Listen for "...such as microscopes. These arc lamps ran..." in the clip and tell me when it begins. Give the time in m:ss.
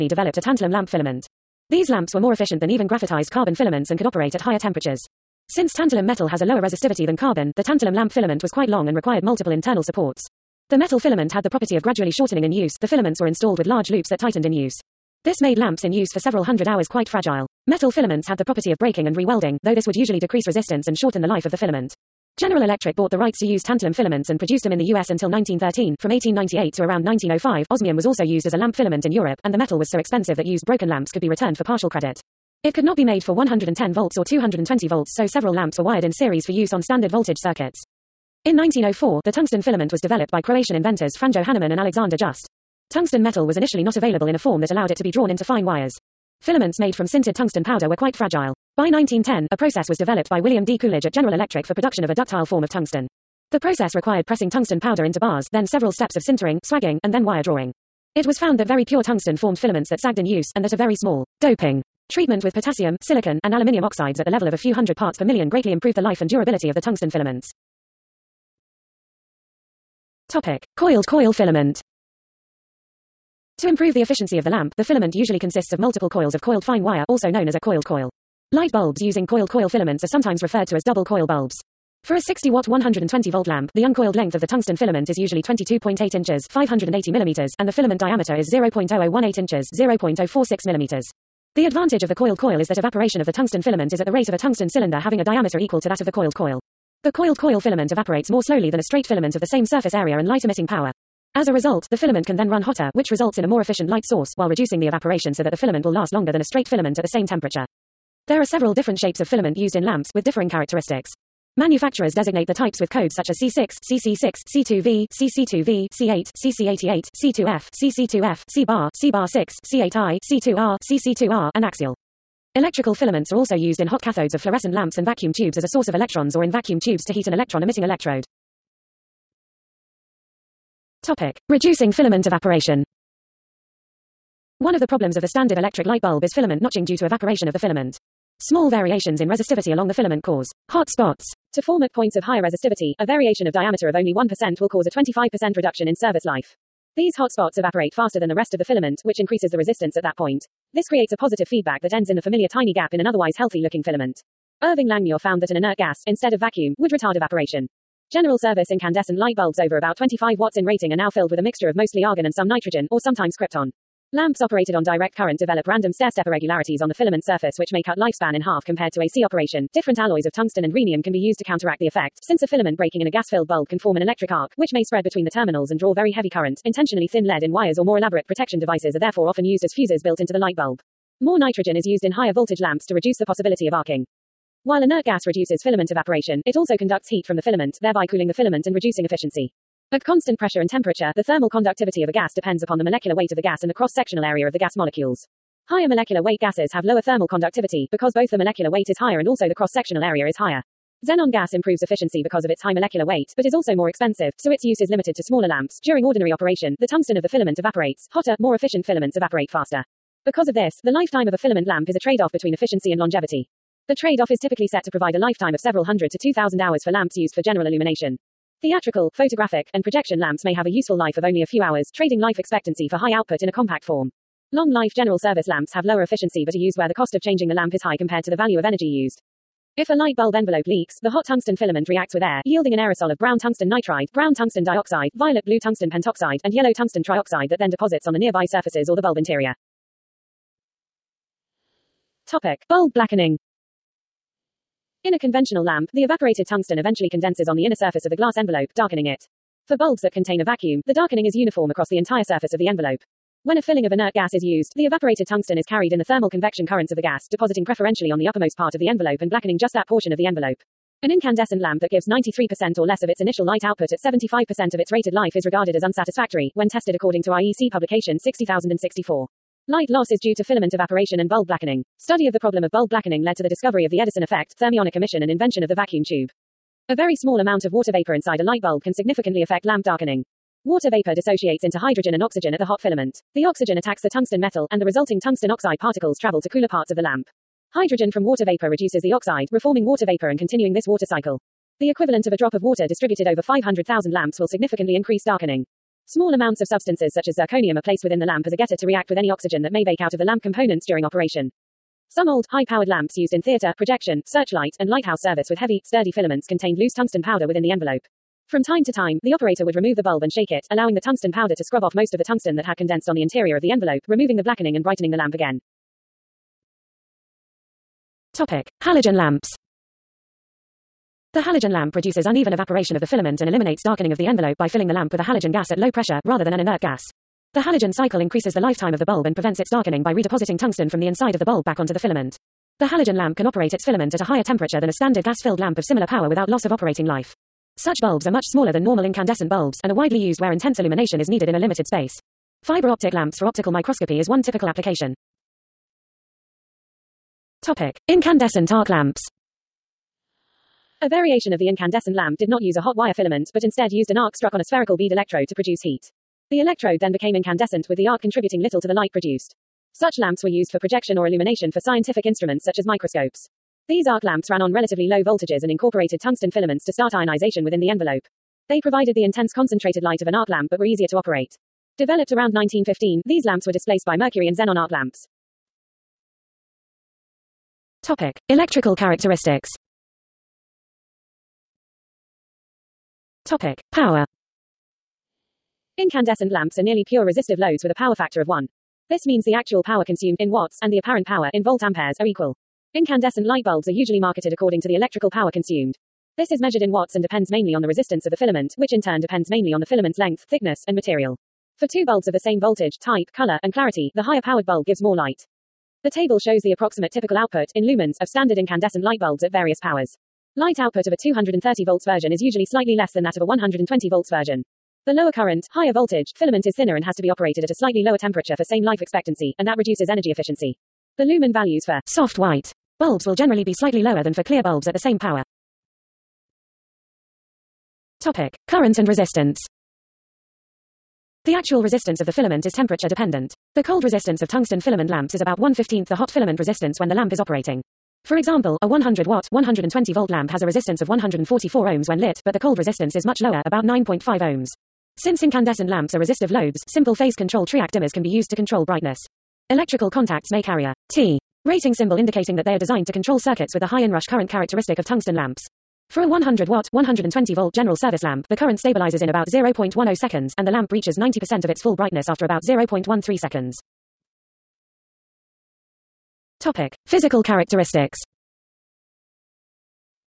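6:02.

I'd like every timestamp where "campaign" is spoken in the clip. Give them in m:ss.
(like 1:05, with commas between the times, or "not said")
not said.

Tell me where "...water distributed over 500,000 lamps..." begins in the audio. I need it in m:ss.
4:52.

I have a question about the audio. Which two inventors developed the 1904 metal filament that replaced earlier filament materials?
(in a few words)
Franjo Hanaman and Alexander Just.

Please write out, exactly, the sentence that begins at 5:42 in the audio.
Fiber optic lamps for optical microscopy is one typical application.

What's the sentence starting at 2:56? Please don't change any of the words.
Intentionally thin lead in wires or more elaborate protection devices are therefore 4 often used as fuses built into the light bulb.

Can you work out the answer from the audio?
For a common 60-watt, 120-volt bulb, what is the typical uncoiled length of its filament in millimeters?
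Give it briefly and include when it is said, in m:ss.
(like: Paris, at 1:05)
580 millimeters, at 1:26.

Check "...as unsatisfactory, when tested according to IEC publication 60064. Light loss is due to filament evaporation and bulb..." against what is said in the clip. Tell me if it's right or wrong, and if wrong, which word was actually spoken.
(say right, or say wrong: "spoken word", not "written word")
right.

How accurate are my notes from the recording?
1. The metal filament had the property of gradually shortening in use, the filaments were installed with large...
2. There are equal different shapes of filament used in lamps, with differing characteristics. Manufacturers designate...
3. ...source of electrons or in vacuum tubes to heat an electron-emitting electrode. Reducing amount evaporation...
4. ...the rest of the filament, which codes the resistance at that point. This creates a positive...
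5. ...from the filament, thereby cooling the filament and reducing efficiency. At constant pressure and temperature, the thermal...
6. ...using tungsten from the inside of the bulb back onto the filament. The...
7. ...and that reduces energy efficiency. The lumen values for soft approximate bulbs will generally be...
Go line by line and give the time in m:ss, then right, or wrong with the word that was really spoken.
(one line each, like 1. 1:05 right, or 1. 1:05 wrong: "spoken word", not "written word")
1. 0:10 right
2. 1:48 wrong: "several", not "equal"
3. 2:05 wrong: "filament", not "amount"
4. 2:28 wrong: "increases", not "codes"
5. 3:07 right
6. 5:30 wrong: "redepositing", not "using"
7. 6:59 wrong: "white", not "approximate".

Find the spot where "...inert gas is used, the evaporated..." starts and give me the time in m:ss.
4:13.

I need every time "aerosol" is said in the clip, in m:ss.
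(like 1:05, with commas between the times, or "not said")
3:52.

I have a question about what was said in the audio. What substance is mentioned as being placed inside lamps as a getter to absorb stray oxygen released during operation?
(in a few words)
Zirconium.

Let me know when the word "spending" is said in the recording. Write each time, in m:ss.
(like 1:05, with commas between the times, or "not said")
not said.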